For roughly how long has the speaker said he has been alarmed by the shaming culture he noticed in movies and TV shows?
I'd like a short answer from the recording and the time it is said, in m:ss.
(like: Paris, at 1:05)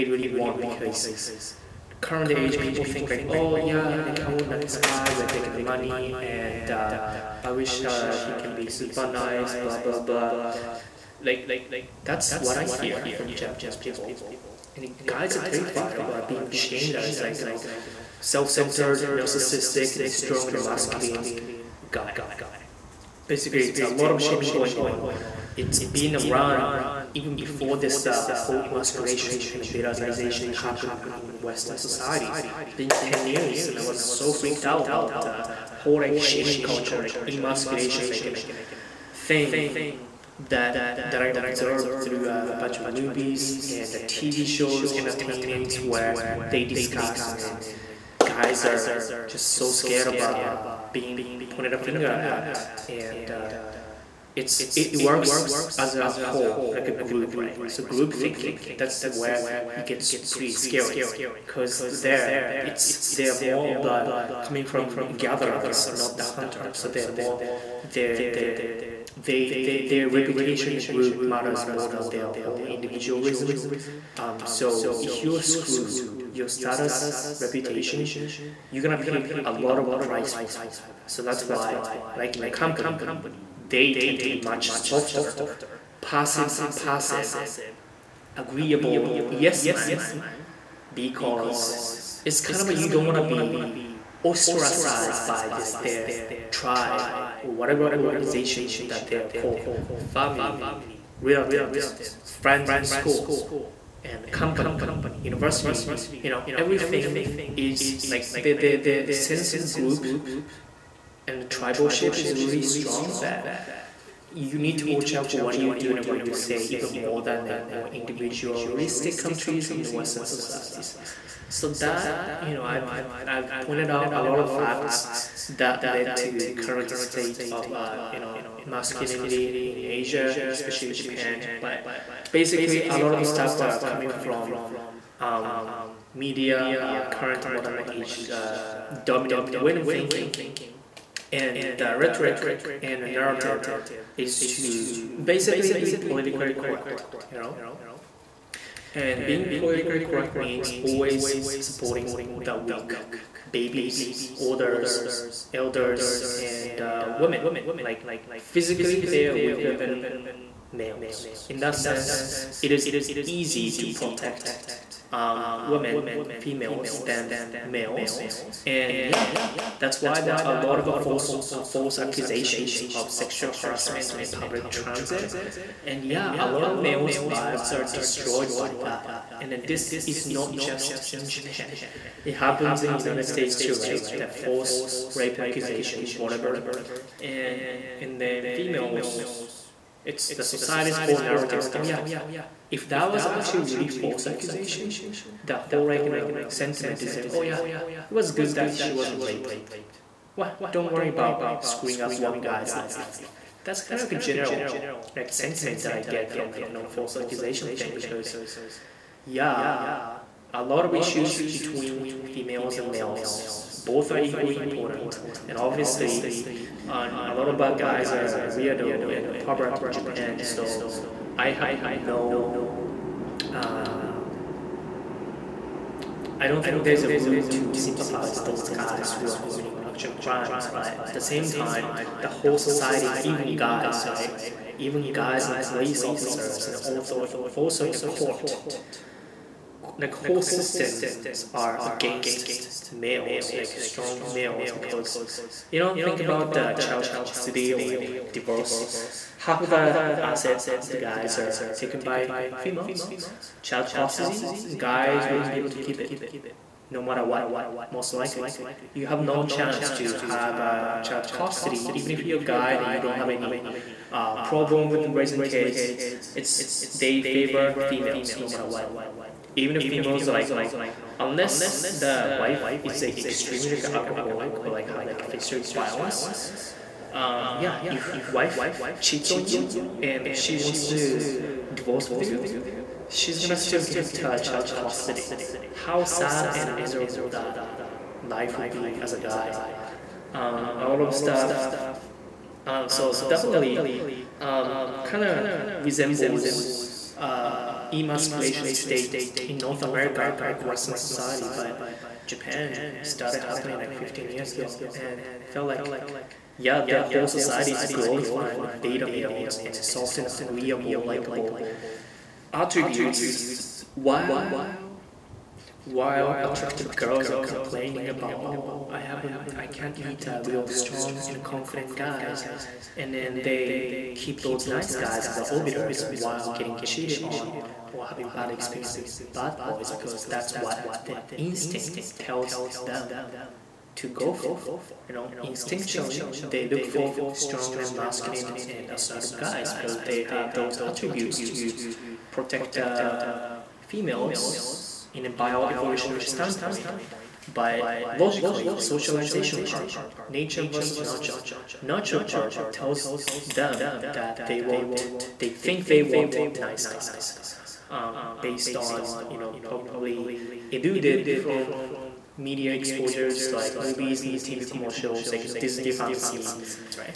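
10 years, at 0:32.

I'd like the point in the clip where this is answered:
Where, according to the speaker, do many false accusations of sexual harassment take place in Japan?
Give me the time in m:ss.
2:54.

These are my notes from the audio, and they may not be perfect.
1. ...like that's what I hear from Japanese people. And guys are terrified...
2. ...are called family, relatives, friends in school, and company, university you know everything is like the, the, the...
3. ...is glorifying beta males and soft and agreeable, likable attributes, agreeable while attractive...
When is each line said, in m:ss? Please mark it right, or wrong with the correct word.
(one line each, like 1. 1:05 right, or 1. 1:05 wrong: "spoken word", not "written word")
1. 0:11 right
2. 1:39 right
3. 5:07 wrong: "while", not "agreeable".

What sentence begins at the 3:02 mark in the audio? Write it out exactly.
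It happens in United States too, right?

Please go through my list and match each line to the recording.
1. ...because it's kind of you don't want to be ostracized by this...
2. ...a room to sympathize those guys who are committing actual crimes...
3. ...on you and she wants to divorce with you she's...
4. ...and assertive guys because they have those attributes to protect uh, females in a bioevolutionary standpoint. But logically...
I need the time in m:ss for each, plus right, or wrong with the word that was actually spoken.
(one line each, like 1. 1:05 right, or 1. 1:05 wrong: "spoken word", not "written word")
1. 1:30 right
2. 3:47 right
3. 4:39 right
4. 5:38 right.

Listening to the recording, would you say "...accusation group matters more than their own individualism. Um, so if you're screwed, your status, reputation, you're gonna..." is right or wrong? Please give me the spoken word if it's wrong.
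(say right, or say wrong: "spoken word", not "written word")
wrong: "reputation", not "accusation".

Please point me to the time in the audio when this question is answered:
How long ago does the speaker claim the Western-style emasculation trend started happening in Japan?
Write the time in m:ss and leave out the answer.
5:03.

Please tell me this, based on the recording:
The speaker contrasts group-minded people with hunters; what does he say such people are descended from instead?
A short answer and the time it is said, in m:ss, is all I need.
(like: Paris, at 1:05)
gatherers, at 1:05.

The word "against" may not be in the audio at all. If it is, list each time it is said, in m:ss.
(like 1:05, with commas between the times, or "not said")
4:01.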